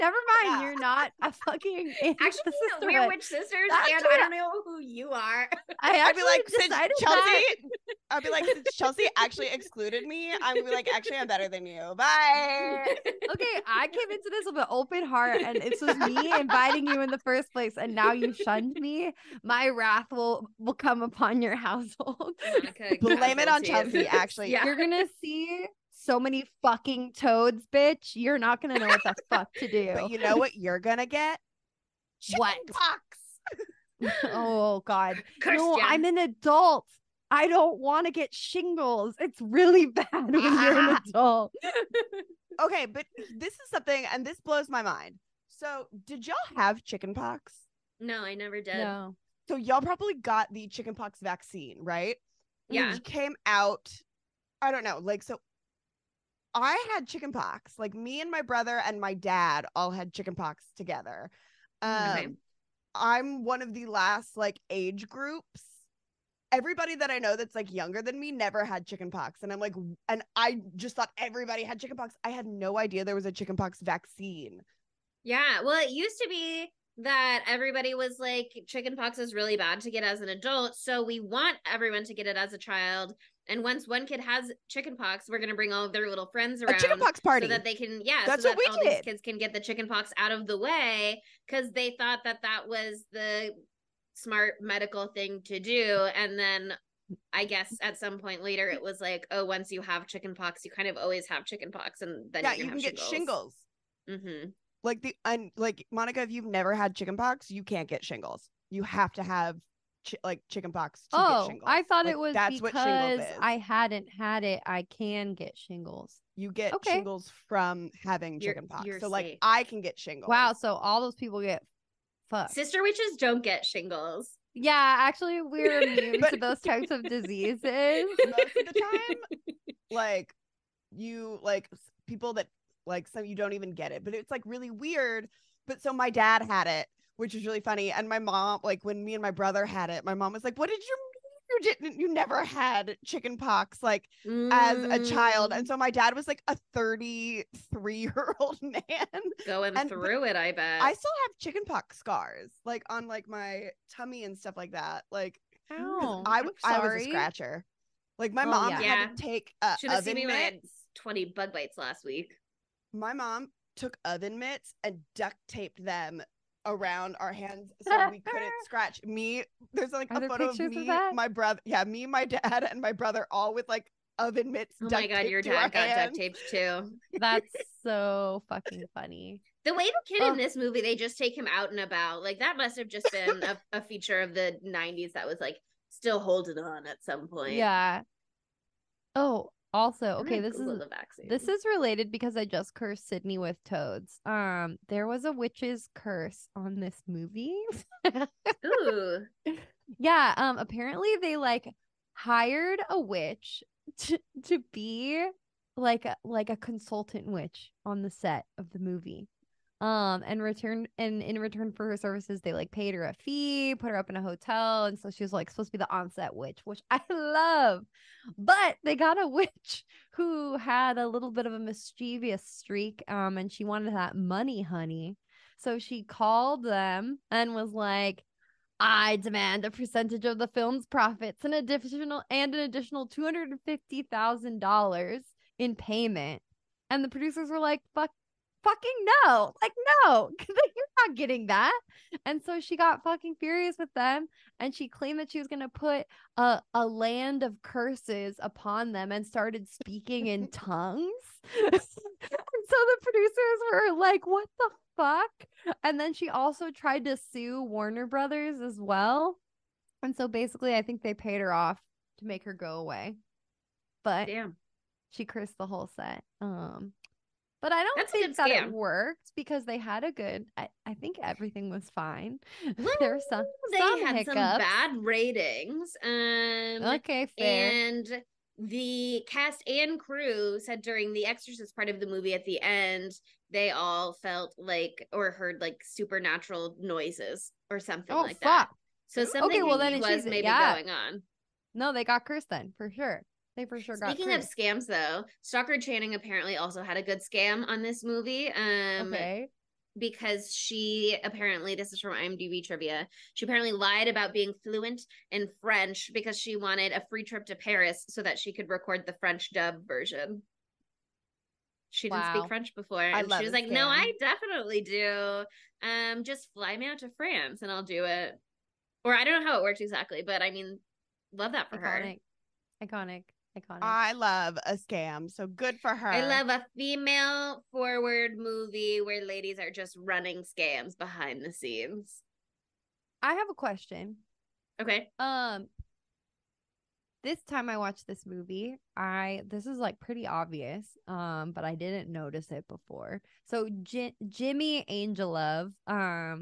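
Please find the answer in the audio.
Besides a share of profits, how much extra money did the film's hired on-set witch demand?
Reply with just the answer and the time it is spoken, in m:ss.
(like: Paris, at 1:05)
$250,000, at 3:53.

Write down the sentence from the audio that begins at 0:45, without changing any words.
So, did y'all have chicken pox?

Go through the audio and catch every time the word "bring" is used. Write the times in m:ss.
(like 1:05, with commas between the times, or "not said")
1:25.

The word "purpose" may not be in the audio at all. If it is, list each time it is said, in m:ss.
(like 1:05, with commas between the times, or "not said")
not said.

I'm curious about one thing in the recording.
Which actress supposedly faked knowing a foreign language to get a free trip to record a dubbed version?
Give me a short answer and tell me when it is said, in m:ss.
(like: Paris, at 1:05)
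Stockard Channing, at 4:55.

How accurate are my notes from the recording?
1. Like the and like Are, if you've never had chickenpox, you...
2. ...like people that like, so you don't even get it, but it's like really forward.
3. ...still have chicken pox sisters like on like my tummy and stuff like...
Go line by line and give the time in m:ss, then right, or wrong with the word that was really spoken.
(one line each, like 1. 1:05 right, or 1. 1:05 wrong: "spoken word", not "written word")
1. 1:44 wrong: "Monica", not "Are"
2. 2:11 wrong: "weird", not "forward"
3. 2:30 wrong: "scars", not "sisters".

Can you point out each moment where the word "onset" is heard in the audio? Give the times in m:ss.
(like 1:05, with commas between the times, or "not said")
3:35.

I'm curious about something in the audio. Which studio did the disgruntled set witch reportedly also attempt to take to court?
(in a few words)
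Warner Brothers.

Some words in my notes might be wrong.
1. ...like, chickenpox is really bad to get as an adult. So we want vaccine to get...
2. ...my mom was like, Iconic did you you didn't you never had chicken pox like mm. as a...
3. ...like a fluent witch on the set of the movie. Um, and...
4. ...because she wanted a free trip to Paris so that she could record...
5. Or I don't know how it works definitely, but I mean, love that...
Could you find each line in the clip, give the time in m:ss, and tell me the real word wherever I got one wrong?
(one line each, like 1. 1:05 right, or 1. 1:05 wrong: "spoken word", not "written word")
1. 1:18 wrong: "everyone", not "vaccine"
2. 2:20 wrong: "What", not "Iconic"
3. 3:26 wrong: "consultant", not "fluent"
4. 5:06 right
5. 5:19 wrong: "exactly", not "definitely".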